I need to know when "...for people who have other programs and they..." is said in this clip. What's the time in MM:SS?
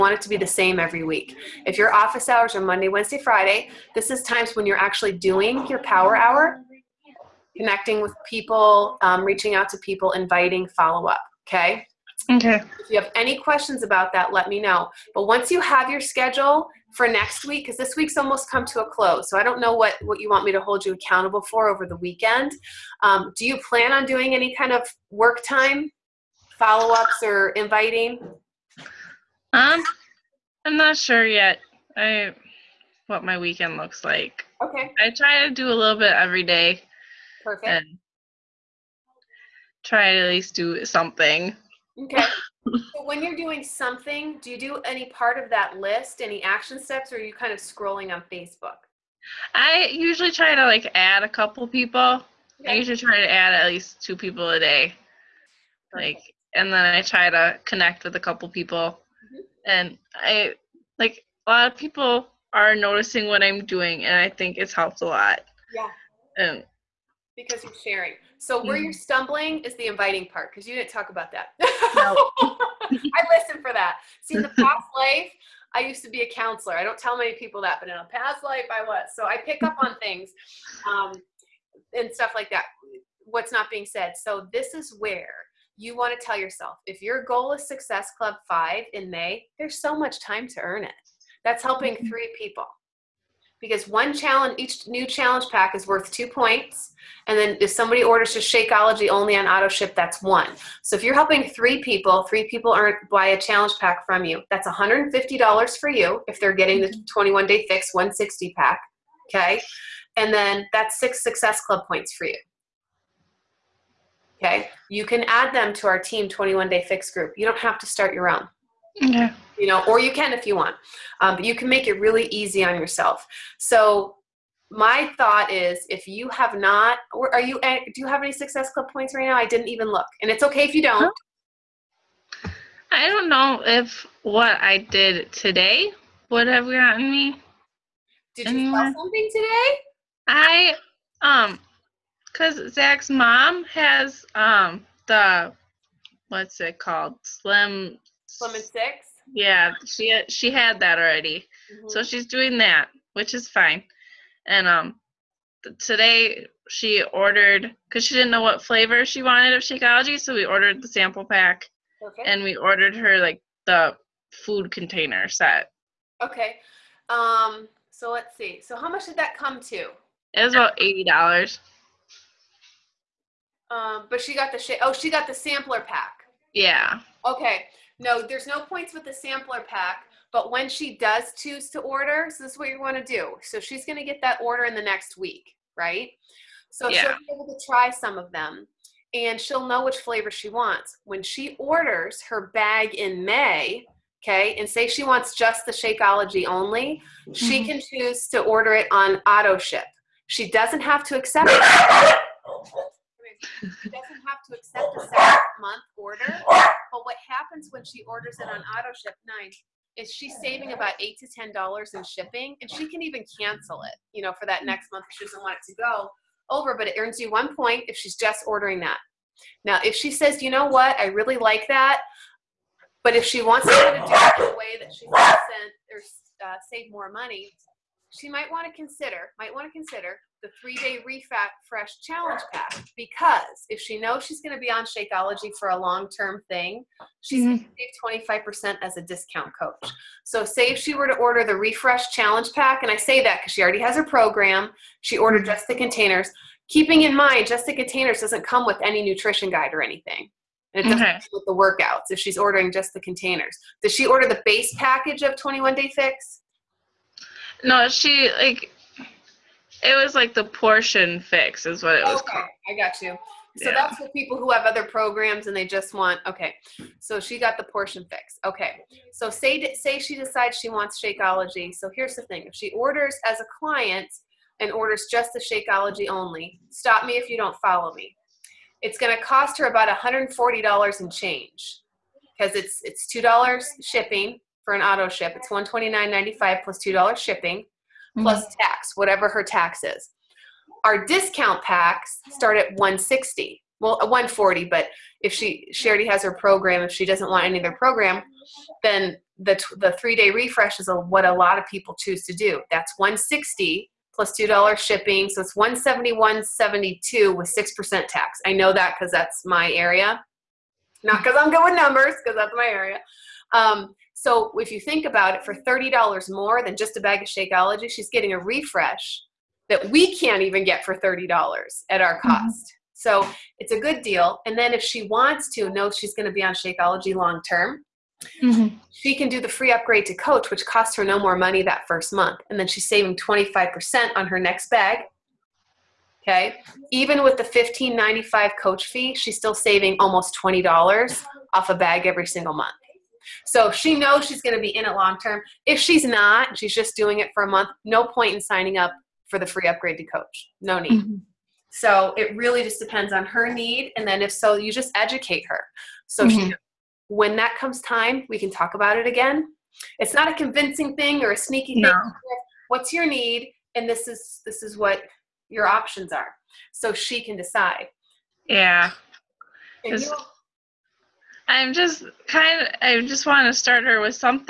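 04:23.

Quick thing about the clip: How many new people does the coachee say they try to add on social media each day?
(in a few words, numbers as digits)
2.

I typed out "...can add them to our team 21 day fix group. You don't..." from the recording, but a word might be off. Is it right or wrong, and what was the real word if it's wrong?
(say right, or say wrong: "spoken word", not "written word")
right.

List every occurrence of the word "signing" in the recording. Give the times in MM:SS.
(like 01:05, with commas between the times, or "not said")
05:48.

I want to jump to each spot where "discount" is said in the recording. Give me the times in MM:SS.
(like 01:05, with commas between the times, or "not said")
03:59, 04:51.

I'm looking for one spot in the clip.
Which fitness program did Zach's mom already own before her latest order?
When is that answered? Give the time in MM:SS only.
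02:28.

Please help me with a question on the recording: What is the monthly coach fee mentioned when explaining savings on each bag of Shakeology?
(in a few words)
$15.95.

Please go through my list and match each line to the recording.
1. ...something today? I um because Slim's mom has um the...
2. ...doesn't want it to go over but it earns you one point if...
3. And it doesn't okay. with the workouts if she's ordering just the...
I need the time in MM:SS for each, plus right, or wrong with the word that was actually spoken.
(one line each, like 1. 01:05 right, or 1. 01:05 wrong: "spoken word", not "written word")
1. 02:18 wrong: "Zach", not "Slim"
2. 03:35 right
3. 04:10 right.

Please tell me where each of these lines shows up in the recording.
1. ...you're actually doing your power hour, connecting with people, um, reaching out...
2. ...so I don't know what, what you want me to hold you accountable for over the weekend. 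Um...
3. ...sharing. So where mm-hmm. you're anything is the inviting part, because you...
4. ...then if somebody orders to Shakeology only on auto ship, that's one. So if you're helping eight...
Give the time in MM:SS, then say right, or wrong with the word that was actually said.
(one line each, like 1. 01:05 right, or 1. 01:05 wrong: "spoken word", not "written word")
1. 00:04 right
2. 00:19 right
3. 01:07 wrong: "stumbling", not "anything"
4. 01:37 wrong: "three", not "eight".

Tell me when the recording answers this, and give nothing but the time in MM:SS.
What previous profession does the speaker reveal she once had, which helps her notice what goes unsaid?
01:16.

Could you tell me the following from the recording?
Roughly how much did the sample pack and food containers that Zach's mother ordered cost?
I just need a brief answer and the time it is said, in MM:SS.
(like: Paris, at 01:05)
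$80, at 02:50.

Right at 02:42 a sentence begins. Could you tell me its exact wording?
and we ordered her like the food container set.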